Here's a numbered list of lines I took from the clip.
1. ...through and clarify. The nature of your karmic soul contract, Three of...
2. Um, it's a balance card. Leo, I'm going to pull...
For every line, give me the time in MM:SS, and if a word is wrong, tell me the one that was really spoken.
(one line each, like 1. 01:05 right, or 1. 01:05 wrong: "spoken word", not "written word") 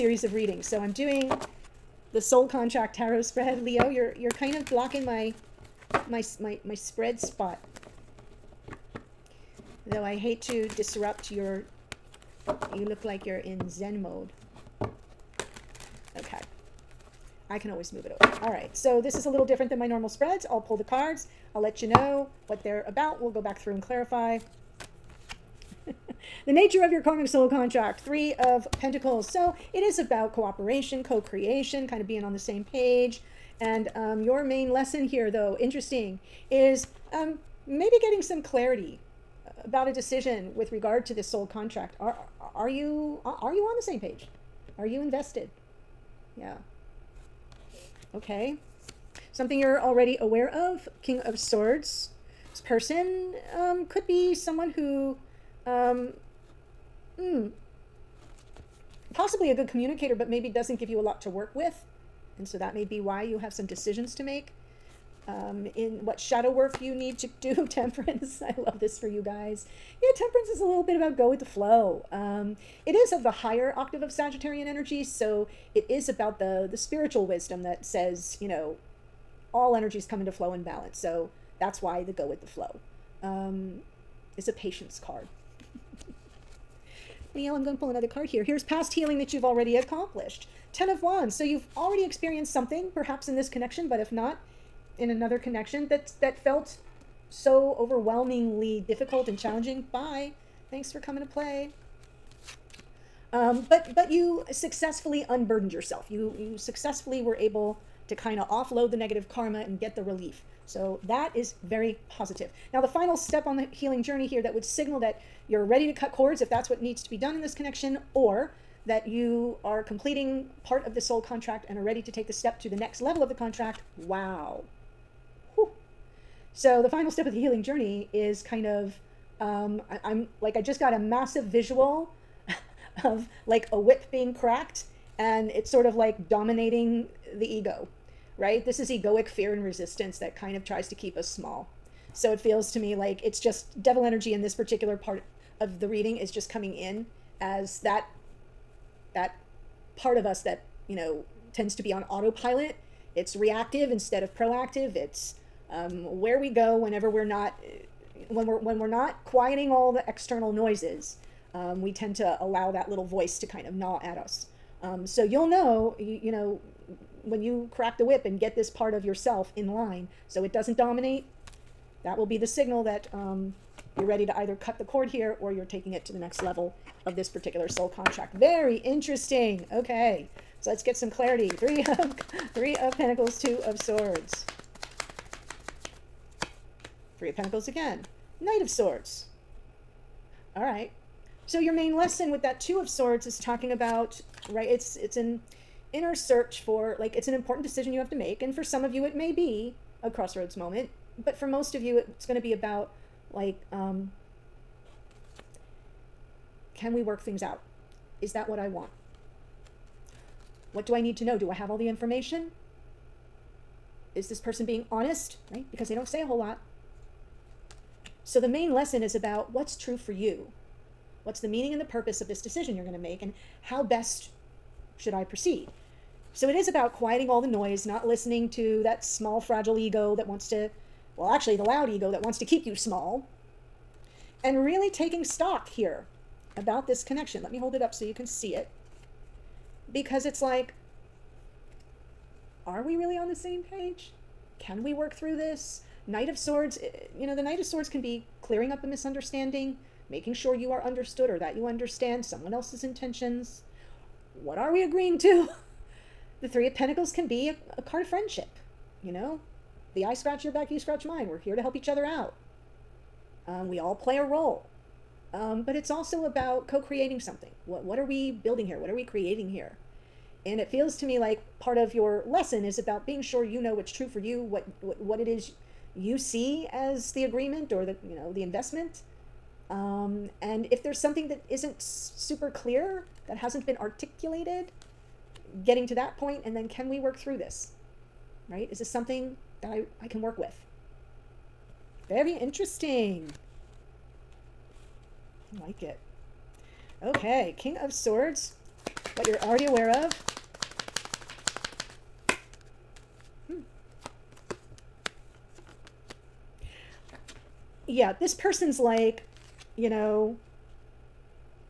1. 00:23 right
2. 01:23 wrong: "patience", not "balance".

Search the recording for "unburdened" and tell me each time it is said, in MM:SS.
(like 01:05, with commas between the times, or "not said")
01:45.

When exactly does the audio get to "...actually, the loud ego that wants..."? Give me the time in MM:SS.
03:51.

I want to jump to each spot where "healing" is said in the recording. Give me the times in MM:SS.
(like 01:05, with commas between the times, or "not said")
01:28, 01:53, 02:07.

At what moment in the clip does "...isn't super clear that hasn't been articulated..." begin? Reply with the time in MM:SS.
04:41.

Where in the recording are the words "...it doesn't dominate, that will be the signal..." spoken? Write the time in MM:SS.
02:50.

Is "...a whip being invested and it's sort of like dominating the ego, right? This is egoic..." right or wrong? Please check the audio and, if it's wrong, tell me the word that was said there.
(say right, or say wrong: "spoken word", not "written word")
wrong: "cracked", not "invested".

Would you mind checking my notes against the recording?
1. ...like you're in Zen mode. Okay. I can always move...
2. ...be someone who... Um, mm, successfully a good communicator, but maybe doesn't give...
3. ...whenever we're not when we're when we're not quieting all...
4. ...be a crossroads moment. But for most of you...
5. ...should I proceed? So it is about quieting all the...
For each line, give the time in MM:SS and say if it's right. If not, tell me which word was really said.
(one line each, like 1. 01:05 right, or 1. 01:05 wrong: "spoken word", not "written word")
1. 00:13 right
2. 00:54 wrong: "possibly", not "successfully"
3. 02:36 right
4. 03:19 right
5. 03:44 right.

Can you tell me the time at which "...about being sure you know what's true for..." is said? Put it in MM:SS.
04:32.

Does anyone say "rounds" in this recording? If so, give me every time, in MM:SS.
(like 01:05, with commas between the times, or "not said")
not said.